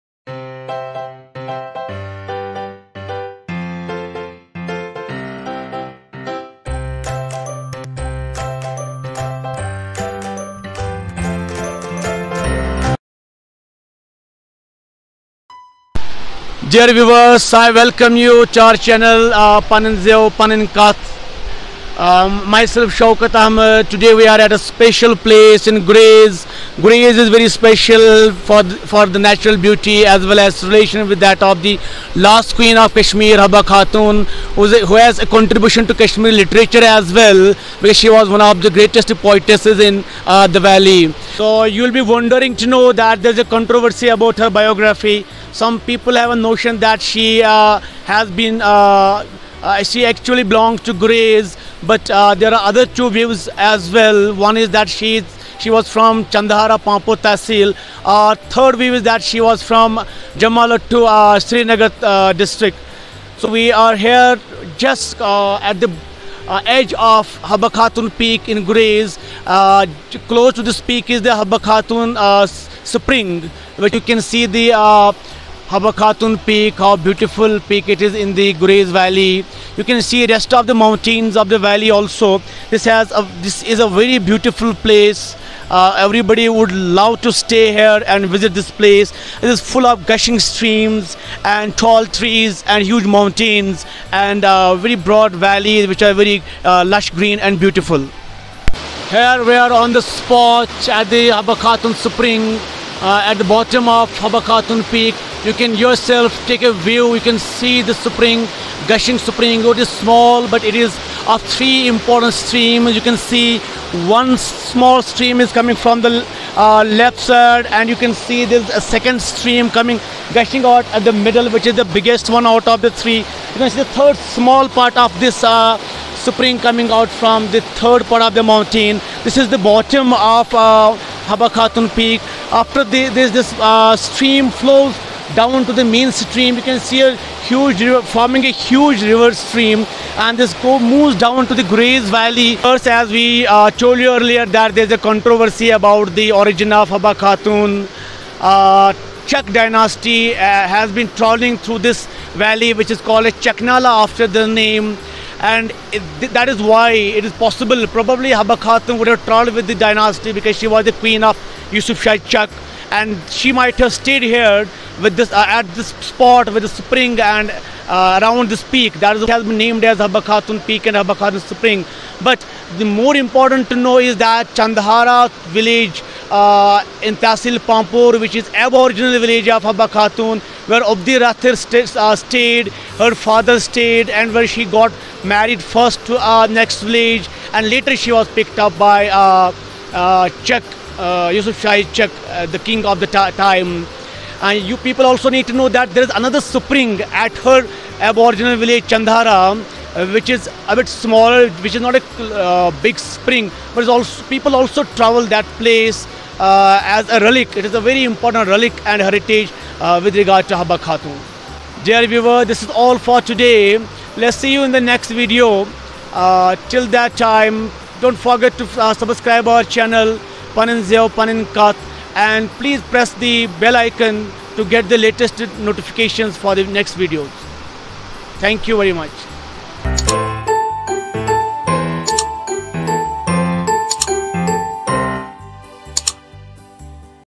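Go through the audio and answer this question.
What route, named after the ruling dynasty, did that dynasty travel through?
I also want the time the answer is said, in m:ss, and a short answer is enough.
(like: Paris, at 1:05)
Chaknala, at 2:33.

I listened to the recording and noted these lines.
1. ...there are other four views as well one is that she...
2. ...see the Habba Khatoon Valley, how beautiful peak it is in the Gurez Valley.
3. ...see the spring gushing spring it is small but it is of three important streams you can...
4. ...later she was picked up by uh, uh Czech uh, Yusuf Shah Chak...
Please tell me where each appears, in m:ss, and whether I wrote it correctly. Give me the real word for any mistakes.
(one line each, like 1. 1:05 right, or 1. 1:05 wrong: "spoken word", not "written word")
1. 0:52 wrong: "two", not "four"
2. 1:14 wrong: "Peak", not "Valley"
3. 1:47 right
4. 3:07 right.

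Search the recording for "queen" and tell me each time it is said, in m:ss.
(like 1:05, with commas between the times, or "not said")
0:32, 2:40.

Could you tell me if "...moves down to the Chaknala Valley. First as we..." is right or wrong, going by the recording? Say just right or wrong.
wrong.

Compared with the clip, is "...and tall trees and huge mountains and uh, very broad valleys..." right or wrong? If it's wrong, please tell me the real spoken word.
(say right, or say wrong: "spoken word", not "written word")
right.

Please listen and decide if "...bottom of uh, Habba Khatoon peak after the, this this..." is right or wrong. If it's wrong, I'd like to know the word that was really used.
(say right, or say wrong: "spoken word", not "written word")
right.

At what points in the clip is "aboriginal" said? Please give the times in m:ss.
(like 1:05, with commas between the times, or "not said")
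2:58, 3:17.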